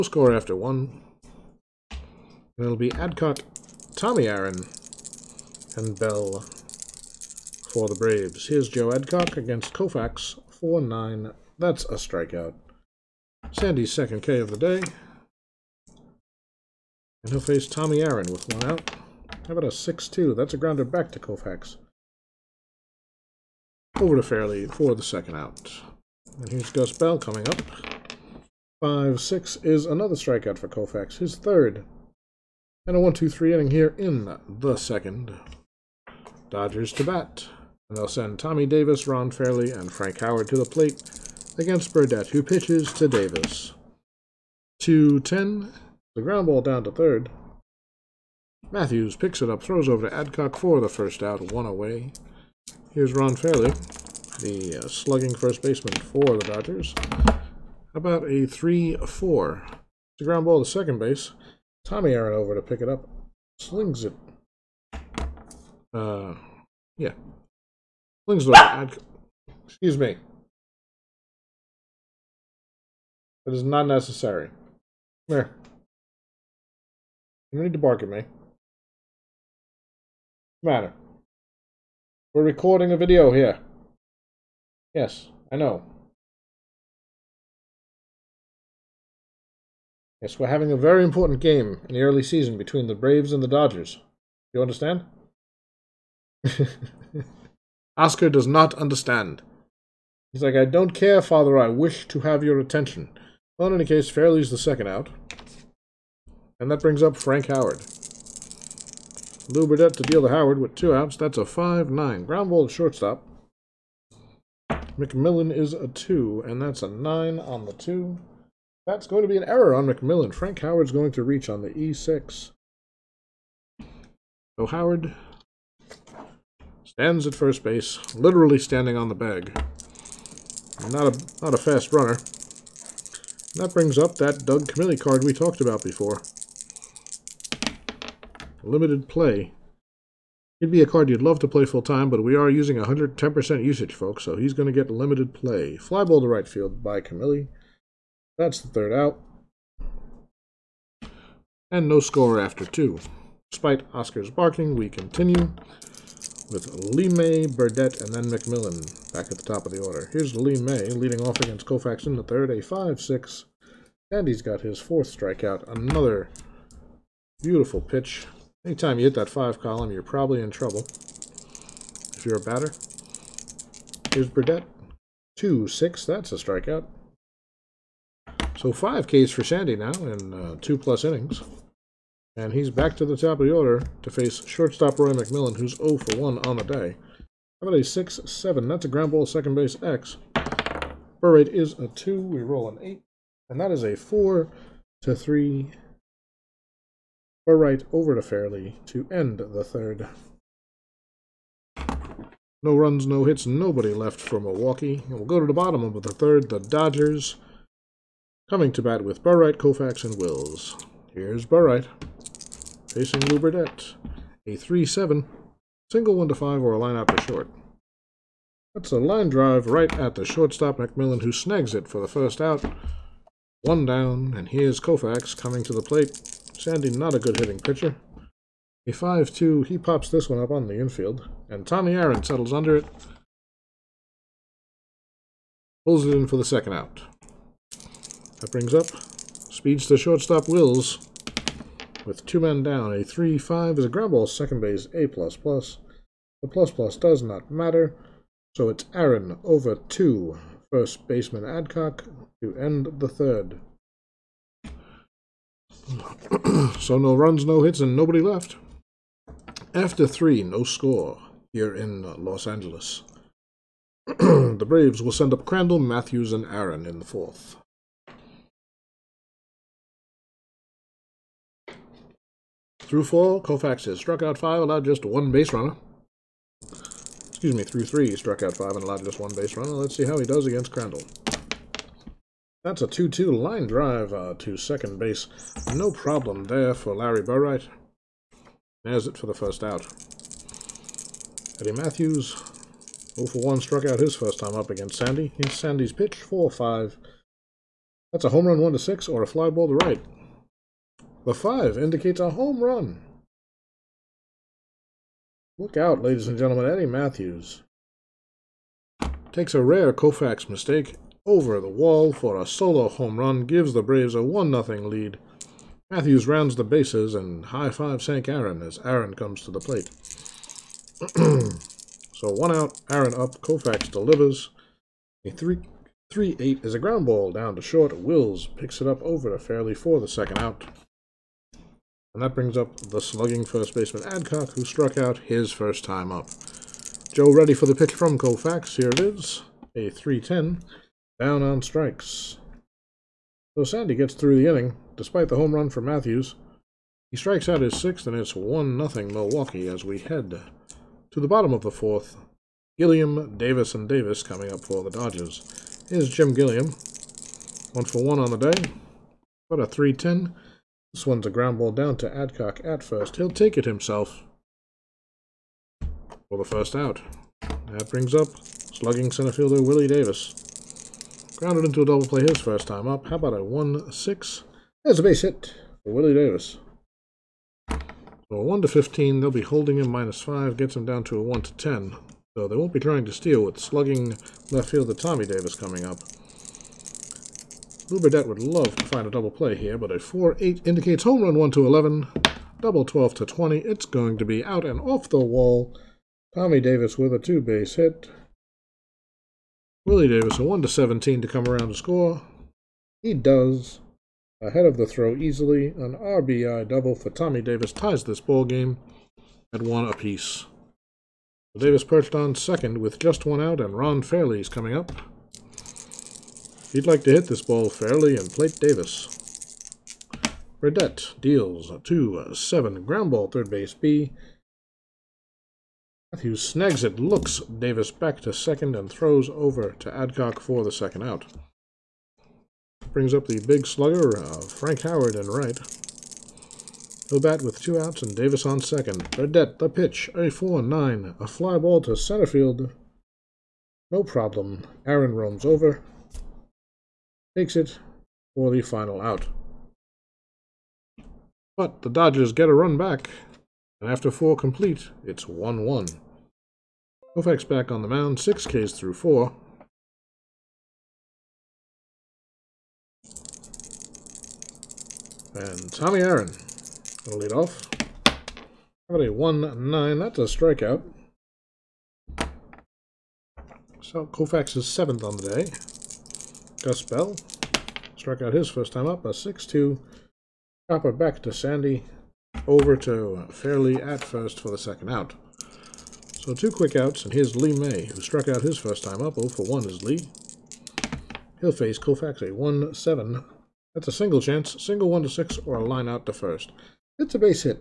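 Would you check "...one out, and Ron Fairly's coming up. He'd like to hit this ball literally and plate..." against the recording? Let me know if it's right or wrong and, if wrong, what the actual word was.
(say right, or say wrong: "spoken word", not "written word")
wrong: "fairly", not "literally".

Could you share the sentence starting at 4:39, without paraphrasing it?
Let's see how he does against Crandall.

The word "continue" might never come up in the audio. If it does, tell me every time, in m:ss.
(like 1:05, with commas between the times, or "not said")
2:34.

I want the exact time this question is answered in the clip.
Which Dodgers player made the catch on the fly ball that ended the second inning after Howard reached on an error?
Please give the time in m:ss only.
2:14.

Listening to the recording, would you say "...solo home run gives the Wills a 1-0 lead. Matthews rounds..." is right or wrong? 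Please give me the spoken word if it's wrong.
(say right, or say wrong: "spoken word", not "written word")
wrong: "Braves", not "Wills".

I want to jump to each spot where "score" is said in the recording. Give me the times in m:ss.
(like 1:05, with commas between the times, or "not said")
0:00, 2:32, 4:20, 6:41.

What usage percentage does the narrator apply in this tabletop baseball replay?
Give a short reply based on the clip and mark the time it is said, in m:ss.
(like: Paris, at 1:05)
110%, at 2:22.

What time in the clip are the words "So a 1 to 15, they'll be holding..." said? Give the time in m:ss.
6:17.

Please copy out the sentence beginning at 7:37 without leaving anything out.
Koufax back on the mound, six Ks through four.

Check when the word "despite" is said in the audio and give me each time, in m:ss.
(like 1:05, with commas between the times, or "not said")
2:33, 5:44.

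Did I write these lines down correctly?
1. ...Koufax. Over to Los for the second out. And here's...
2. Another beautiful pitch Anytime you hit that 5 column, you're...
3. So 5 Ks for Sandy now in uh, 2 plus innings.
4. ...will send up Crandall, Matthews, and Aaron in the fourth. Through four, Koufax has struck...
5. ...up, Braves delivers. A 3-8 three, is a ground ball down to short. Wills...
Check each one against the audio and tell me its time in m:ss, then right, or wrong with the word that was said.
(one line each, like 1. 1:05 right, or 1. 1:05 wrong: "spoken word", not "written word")
1. 0:21 wrong: "Fairly", not "Los"
2. 2:45 right
3. 2:58 right
4. 4:25 right
5. 5:23 wrong: "Koufax", not "Braves".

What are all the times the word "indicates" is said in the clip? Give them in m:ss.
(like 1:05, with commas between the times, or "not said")
5:01, 6:30.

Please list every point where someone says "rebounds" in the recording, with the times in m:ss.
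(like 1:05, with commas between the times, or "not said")
not said.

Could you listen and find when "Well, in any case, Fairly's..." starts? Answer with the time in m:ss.
1:43.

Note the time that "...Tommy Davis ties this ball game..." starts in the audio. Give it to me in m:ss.
6:47.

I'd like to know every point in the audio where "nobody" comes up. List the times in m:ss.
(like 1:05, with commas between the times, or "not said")
3:23, 4:17.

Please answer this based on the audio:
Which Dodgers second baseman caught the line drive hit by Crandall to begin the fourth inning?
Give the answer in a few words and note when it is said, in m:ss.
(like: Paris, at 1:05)
Larry Burright, at 4:46.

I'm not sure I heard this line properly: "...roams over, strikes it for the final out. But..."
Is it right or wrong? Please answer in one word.
wrong.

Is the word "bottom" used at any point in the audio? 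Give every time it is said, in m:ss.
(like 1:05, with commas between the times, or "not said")
3:25, 5:51.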